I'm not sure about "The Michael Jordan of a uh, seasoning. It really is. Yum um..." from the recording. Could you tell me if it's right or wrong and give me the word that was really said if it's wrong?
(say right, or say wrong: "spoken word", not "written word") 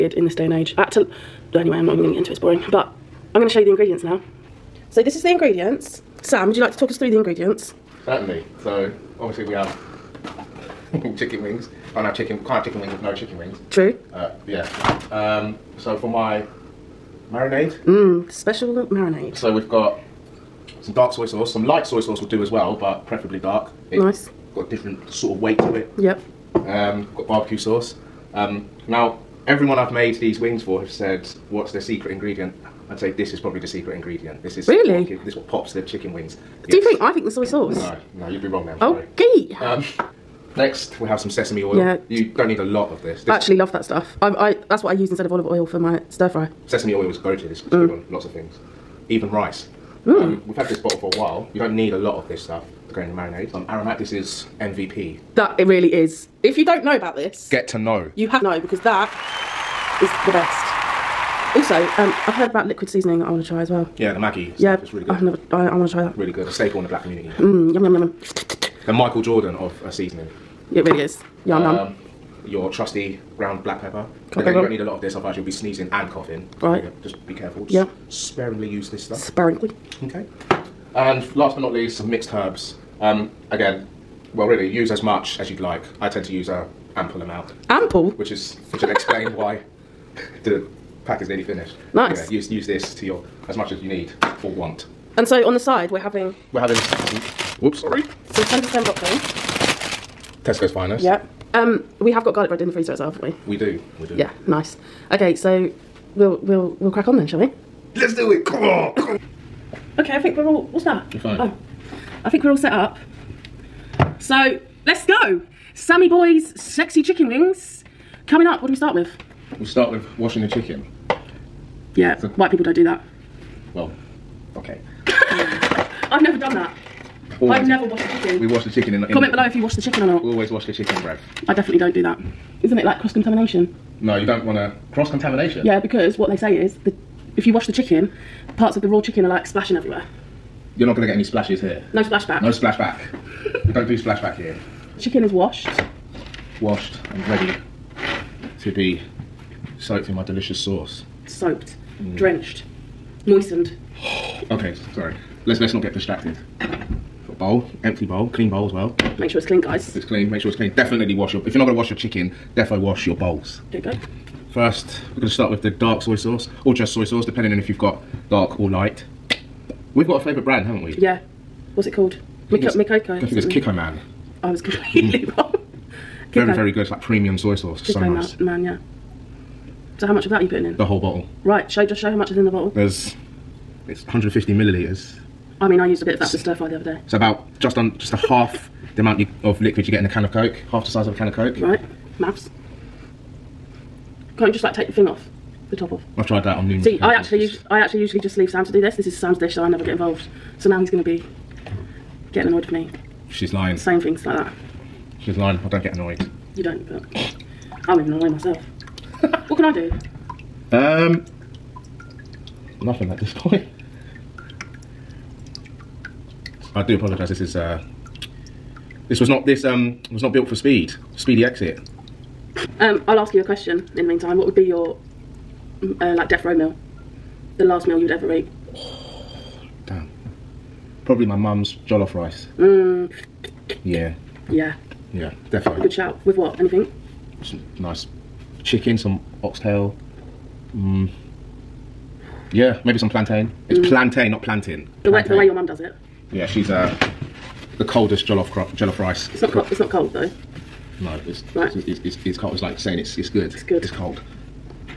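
right.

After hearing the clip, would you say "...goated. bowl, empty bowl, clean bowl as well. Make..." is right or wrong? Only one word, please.
wrong.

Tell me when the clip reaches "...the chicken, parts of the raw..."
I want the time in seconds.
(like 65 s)
137 s.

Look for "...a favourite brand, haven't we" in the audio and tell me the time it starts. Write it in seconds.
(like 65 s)
170 s.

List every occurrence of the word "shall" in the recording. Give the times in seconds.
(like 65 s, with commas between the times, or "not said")
107 s.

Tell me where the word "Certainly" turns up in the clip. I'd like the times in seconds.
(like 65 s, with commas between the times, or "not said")
8 s.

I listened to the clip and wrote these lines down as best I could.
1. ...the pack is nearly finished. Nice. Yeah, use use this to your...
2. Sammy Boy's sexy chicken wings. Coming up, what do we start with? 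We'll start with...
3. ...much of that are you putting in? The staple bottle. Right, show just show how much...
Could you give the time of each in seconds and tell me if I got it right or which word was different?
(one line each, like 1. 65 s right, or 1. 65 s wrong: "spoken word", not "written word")
1. 90 s right
2. 115 s right
3. 180 s wrong: "whole", not "staple".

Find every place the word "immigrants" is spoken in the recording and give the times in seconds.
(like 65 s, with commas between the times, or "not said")
not said.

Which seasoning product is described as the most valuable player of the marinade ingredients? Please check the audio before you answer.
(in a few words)
Aromat.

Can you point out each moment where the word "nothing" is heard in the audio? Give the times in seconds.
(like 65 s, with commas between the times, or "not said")
212 s.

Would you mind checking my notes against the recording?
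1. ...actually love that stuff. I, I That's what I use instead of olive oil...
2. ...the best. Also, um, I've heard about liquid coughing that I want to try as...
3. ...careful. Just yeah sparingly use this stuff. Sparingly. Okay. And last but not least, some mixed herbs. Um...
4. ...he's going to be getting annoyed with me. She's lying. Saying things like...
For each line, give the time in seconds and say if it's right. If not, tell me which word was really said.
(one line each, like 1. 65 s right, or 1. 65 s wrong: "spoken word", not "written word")
1. 43 s right
2. 60 s wrong: "seasoning", not "coughing"
3. 77 s right
4. 200 s right.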